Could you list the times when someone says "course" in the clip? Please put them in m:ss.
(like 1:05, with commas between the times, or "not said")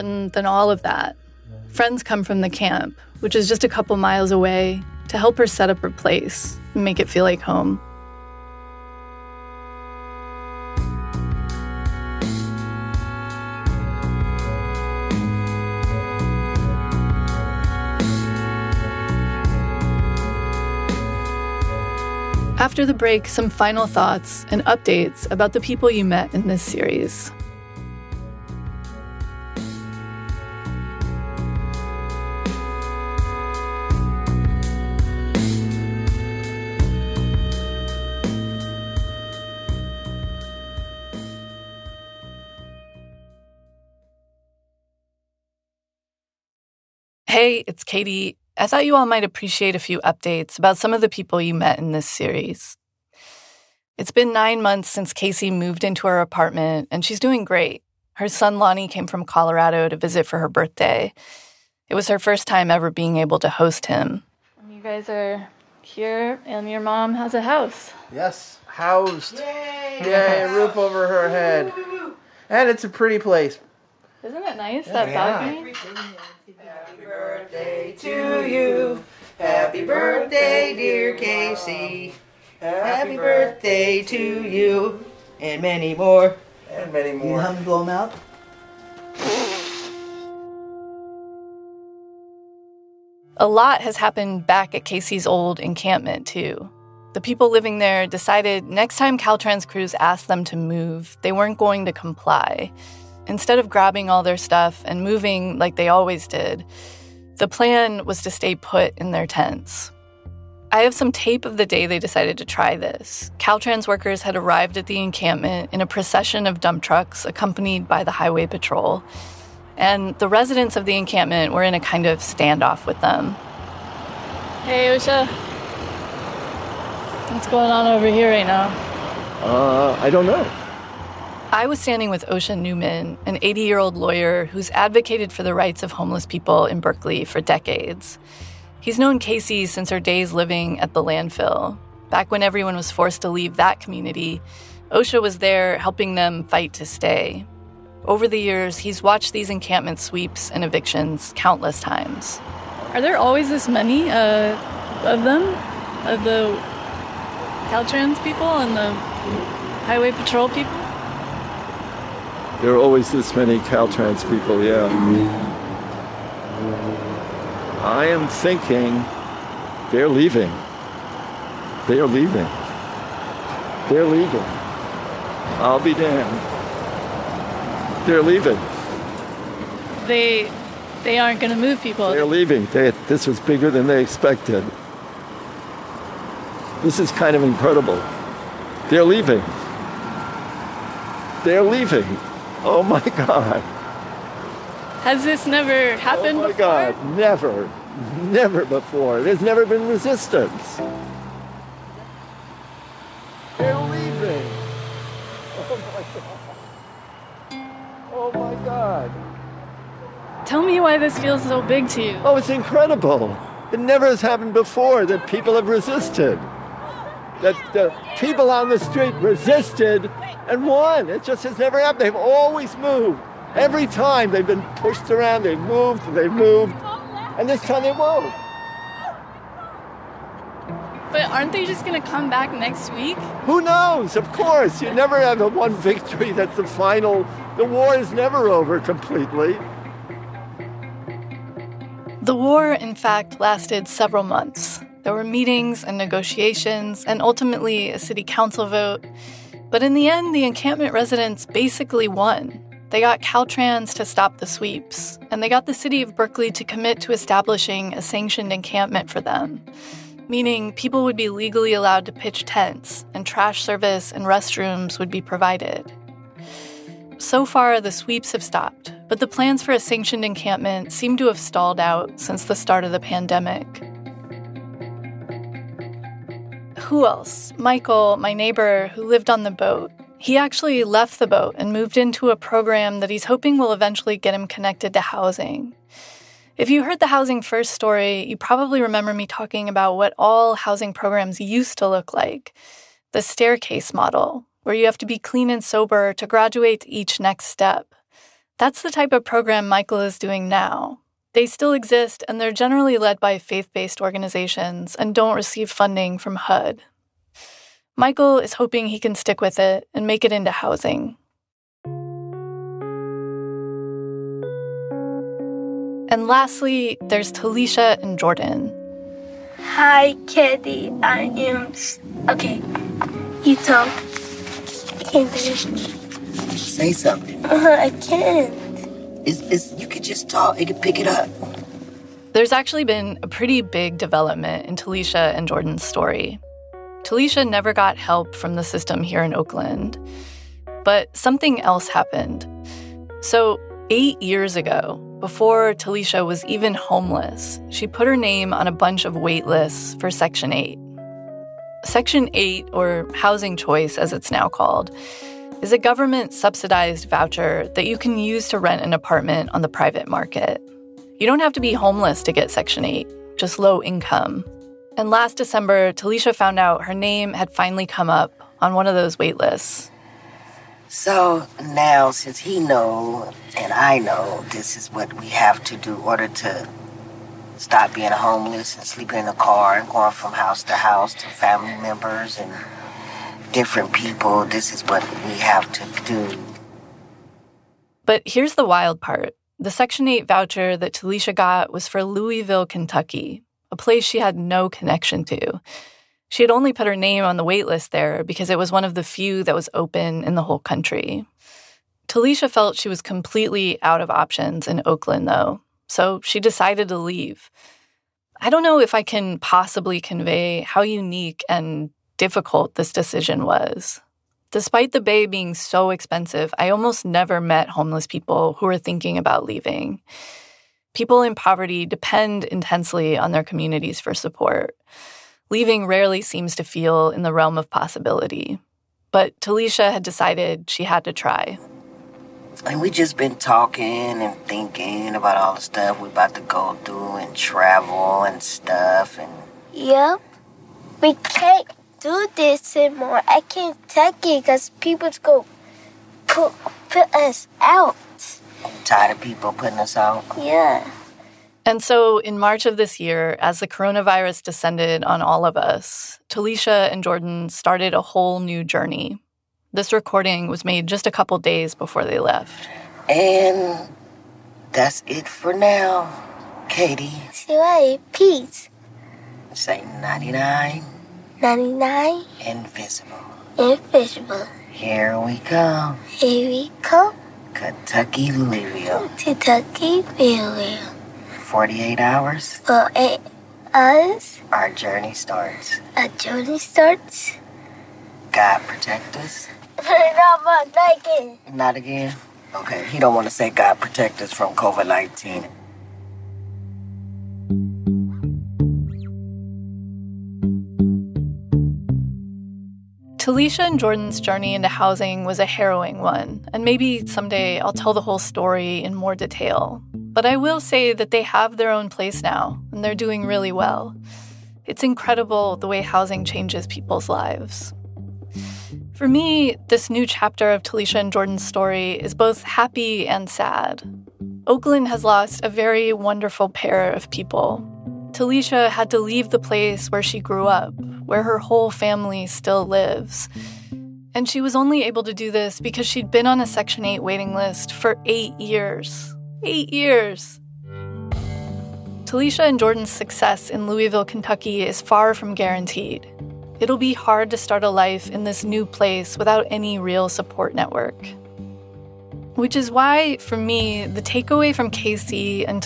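3:54.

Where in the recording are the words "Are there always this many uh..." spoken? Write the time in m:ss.
2:32.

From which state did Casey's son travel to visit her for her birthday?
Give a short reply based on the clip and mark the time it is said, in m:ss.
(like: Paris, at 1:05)
Colorado, at 0:59.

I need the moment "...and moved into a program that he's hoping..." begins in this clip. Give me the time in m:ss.
4:41.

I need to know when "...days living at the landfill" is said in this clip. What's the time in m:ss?
2:19.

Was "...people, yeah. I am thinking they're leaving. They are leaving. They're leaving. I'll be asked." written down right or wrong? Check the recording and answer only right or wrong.
wrong.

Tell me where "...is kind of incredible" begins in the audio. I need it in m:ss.
3:06.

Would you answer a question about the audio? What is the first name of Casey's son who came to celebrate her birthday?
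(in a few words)
Lonnie.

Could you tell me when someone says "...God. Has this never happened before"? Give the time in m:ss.
3:12.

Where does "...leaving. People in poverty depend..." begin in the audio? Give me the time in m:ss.
6:59.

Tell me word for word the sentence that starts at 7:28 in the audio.
I'm tired of people putting us out.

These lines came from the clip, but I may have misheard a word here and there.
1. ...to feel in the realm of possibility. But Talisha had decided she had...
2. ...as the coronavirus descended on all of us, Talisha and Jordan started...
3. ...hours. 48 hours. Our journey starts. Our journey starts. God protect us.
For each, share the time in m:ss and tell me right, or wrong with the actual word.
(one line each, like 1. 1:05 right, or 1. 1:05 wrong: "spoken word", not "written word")
1. 7:06 right
2. 7:33 right
3. 8:01 right.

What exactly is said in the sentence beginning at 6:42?
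Talisha felt she was completely out of options in Oakland, though, so she decided to leave.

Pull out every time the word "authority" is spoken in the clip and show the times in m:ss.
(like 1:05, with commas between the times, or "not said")
not said.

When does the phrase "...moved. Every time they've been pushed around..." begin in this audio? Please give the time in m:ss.
3:42.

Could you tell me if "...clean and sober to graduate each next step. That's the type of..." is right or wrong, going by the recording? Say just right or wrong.
right.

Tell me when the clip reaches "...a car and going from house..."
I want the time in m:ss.
6:19.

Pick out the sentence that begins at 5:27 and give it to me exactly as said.
Uh, I can't is, is you could just talk, you could pick it up.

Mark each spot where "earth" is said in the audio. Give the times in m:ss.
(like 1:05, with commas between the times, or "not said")
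not said.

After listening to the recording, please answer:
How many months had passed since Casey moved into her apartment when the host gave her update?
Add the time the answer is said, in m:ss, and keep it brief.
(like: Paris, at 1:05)
9, at 0:54.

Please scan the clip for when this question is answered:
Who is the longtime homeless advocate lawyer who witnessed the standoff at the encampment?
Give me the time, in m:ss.
2:12.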